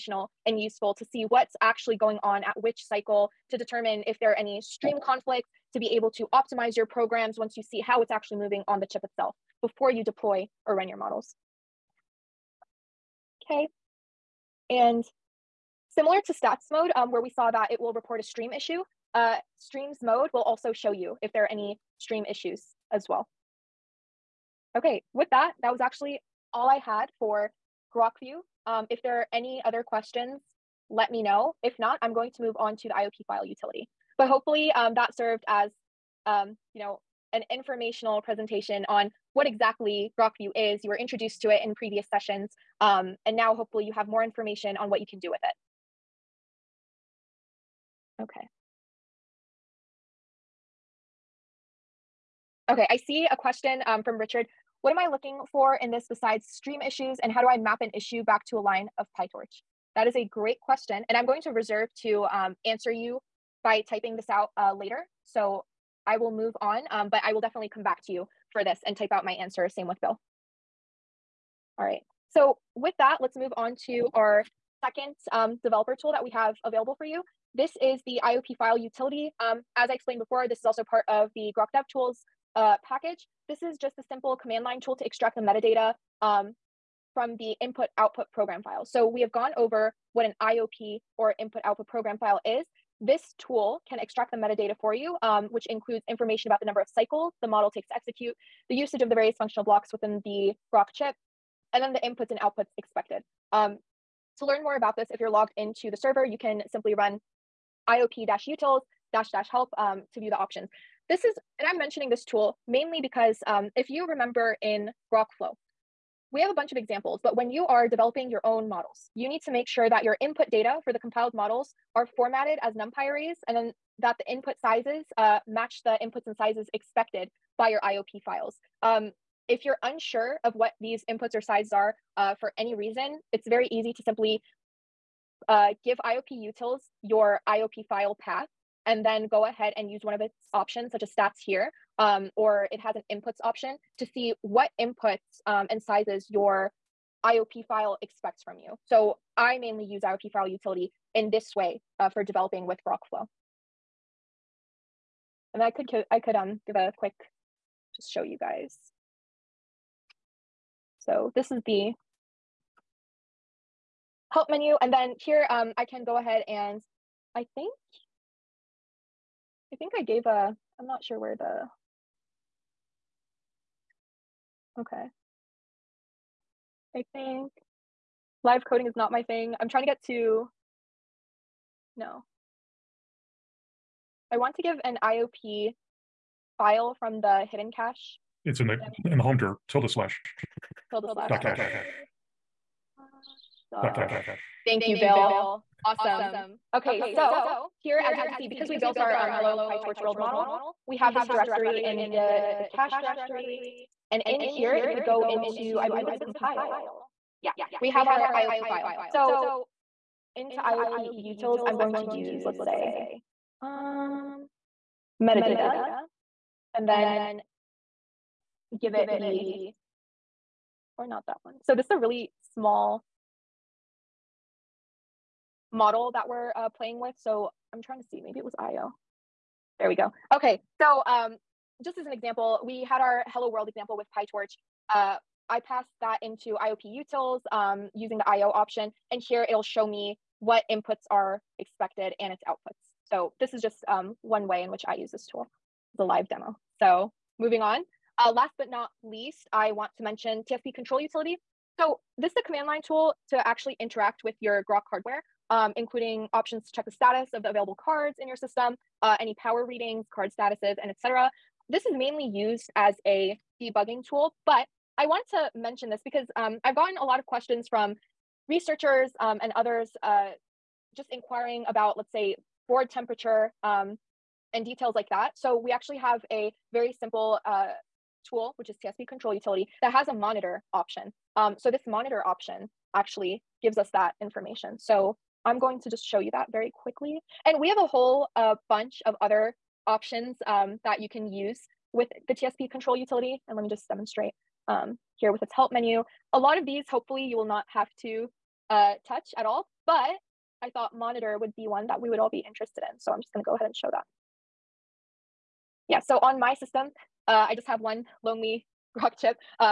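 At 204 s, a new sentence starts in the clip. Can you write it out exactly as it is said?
And in here, if we go into, I believe it's compile, yeah, we have our IOP file.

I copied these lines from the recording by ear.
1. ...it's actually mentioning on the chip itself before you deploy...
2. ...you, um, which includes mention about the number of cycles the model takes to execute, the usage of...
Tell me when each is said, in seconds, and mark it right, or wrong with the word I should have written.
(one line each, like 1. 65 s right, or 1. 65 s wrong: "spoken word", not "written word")
1. 8 s wrong: "moving", not "mentioning"
2. 94 s wrong: "information", not "mention".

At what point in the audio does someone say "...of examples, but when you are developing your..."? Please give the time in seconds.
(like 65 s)
116 s.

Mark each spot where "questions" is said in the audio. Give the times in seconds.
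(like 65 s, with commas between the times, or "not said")
29 s, 53 s, 60 s, 267 s.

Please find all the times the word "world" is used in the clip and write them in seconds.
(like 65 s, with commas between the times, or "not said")
200 s, 233 s.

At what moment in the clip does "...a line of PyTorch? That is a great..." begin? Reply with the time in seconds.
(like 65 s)
58 s.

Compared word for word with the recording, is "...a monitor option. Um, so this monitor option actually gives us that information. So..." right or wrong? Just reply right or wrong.
right.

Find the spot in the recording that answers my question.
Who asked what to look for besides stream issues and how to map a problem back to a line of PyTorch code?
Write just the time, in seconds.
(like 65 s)
54 s.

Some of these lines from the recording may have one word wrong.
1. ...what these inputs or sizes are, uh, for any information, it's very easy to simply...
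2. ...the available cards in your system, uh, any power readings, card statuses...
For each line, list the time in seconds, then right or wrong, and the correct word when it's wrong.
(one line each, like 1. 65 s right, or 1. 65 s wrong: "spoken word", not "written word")
1. 130 s wrong: "reason", not "information"
2. 257 s right.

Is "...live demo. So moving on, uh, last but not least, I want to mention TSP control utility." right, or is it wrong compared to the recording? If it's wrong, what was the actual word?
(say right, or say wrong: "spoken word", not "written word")
right.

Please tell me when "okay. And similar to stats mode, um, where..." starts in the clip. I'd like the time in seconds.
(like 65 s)
13 s.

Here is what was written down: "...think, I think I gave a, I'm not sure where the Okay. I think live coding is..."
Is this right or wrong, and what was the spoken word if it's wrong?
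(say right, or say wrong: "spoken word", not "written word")
right.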